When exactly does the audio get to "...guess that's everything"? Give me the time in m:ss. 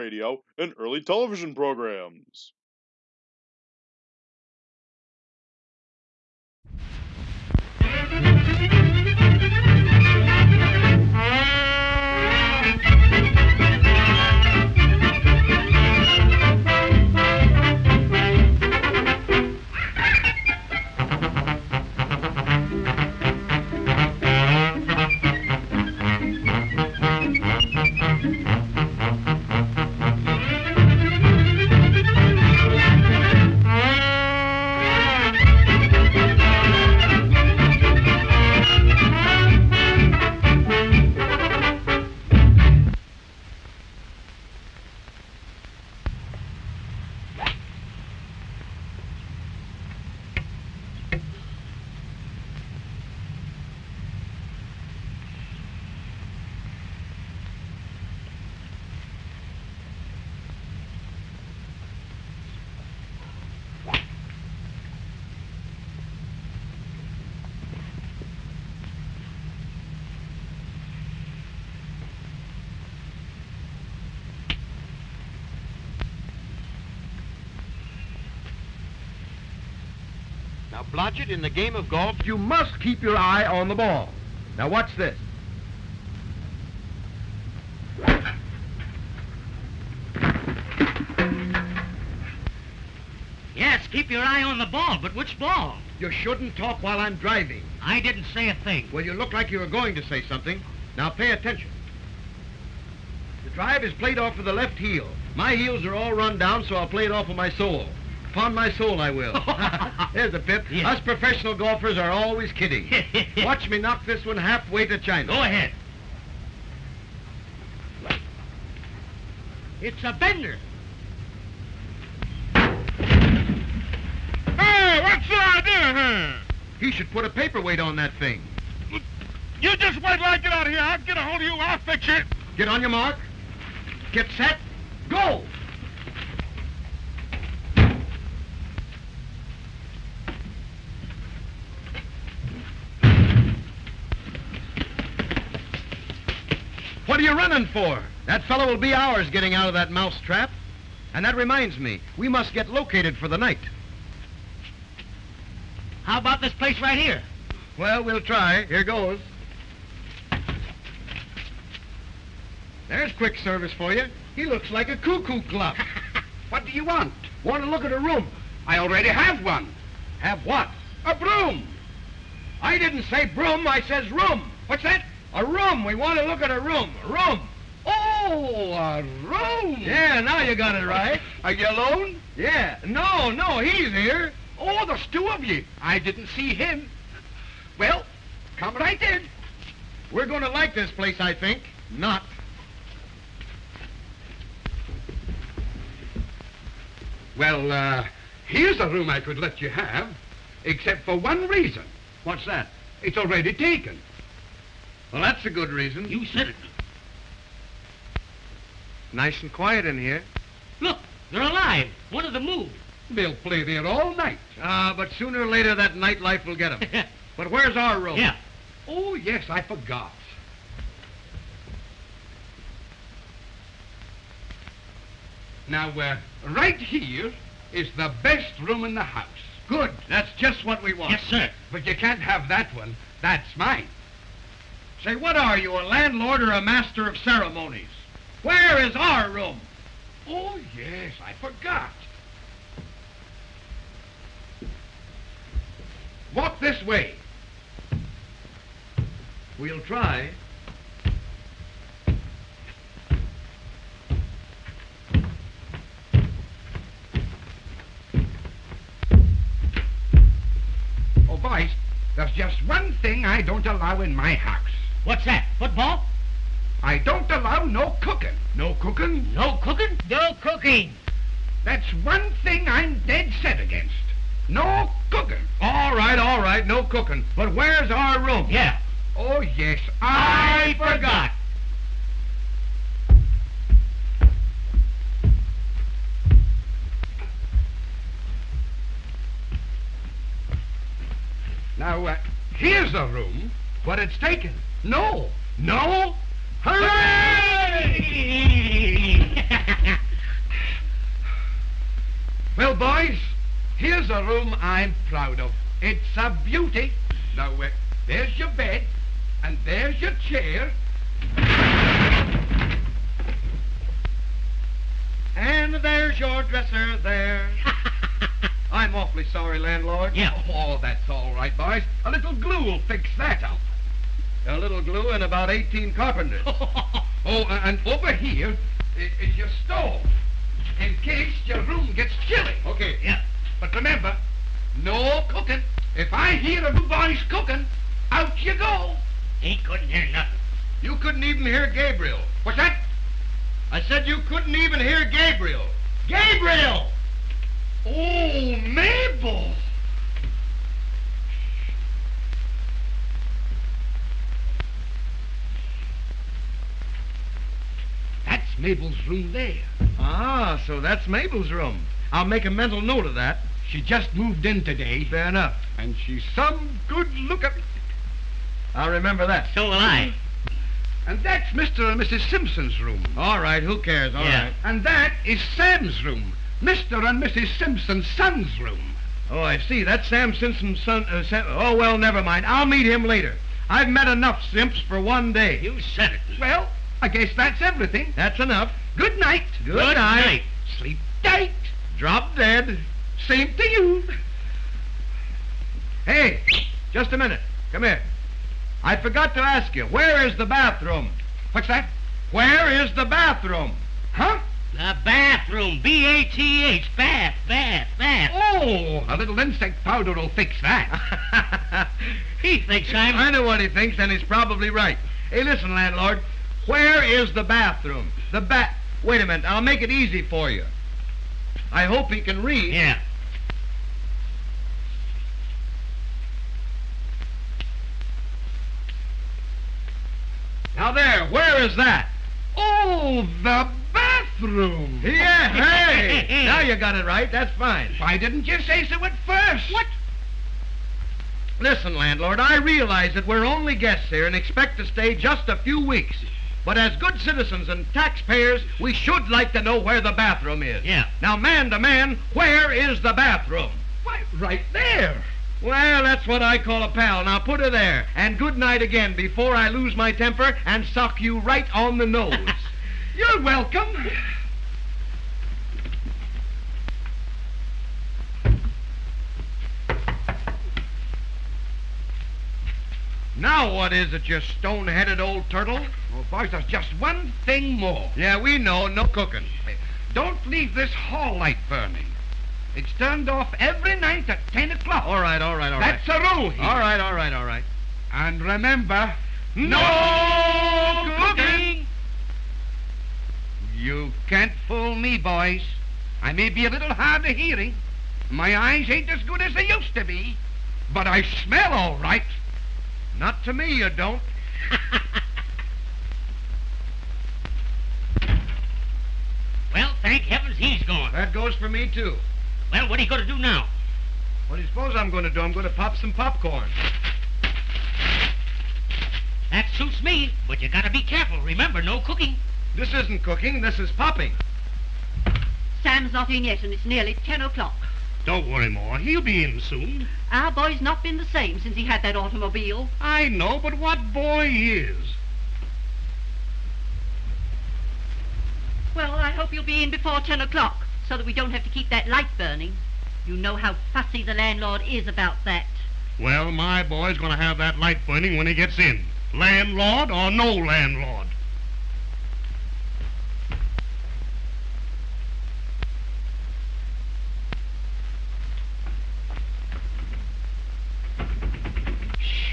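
6:27.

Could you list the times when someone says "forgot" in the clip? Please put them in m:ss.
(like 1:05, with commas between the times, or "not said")
3:39, 4:01, 4:40, 6:38.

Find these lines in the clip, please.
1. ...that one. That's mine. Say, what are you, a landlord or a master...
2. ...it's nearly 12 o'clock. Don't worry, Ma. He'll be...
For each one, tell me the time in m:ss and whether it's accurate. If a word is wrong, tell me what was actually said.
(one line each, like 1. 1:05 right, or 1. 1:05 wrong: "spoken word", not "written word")
1. 3:52 right
2. 8:46 wrong: "10", not "12".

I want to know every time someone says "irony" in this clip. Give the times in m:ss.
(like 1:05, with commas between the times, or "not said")
not said.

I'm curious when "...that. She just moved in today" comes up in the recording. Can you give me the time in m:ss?
6:03.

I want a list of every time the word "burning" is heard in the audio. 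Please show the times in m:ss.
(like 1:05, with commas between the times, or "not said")
8:01, 9:02, 9:08.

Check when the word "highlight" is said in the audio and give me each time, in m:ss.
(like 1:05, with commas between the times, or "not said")
not said.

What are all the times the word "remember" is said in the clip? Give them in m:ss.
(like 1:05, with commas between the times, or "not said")
5:33, 6:08, 8:08, 8:41.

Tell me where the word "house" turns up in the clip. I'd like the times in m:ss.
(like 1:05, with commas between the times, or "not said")
3:49, 4:24.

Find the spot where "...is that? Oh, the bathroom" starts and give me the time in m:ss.
7:11.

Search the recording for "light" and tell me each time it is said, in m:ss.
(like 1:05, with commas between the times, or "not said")
8:01, 9:02, 9:07.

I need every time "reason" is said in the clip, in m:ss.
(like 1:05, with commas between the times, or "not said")
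3:21, 3:25.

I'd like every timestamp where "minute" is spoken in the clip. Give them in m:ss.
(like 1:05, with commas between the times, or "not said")
6:37, 6:59.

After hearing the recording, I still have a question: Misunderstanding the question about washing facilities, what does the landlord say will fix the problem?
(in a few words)
Insect powder.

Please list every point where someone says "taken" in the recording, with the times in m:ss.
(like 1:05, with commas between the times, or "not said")
3:23, 4:54.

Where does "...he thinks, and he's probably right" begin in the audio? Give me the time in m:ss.
6:53.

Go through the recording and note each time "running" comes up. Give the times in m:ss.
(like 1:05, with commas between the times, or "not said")
2:27.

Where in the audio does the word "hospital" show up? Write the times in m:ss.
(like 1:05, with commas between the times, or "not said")
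not said.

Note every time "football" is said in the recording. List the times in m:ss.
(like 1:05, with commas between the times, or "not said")
4:25.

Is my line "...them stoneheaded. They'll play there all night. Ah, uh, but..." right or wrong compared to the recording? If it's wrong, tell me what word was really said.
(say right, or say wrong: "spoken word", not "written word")
wrong: "moved", not "stoneheaded".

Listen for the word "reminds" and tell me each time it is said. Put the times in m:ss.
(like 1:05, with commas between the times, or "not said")
2:31.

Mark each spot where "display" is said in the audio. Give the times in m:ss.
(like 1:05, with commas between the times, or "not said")
not said.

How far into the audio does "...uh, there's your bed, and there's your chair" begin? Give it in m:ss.
5:07.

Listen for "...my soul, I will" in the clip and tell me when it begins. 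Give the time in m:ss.
1:48.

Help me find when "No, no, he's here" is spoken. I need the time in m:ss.
3:02.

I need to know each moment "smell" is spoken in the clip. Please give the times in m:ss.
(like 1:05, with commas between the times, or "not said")
8:21.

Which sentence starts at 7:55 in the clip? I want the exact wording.
Well, boys, there's just one thing more.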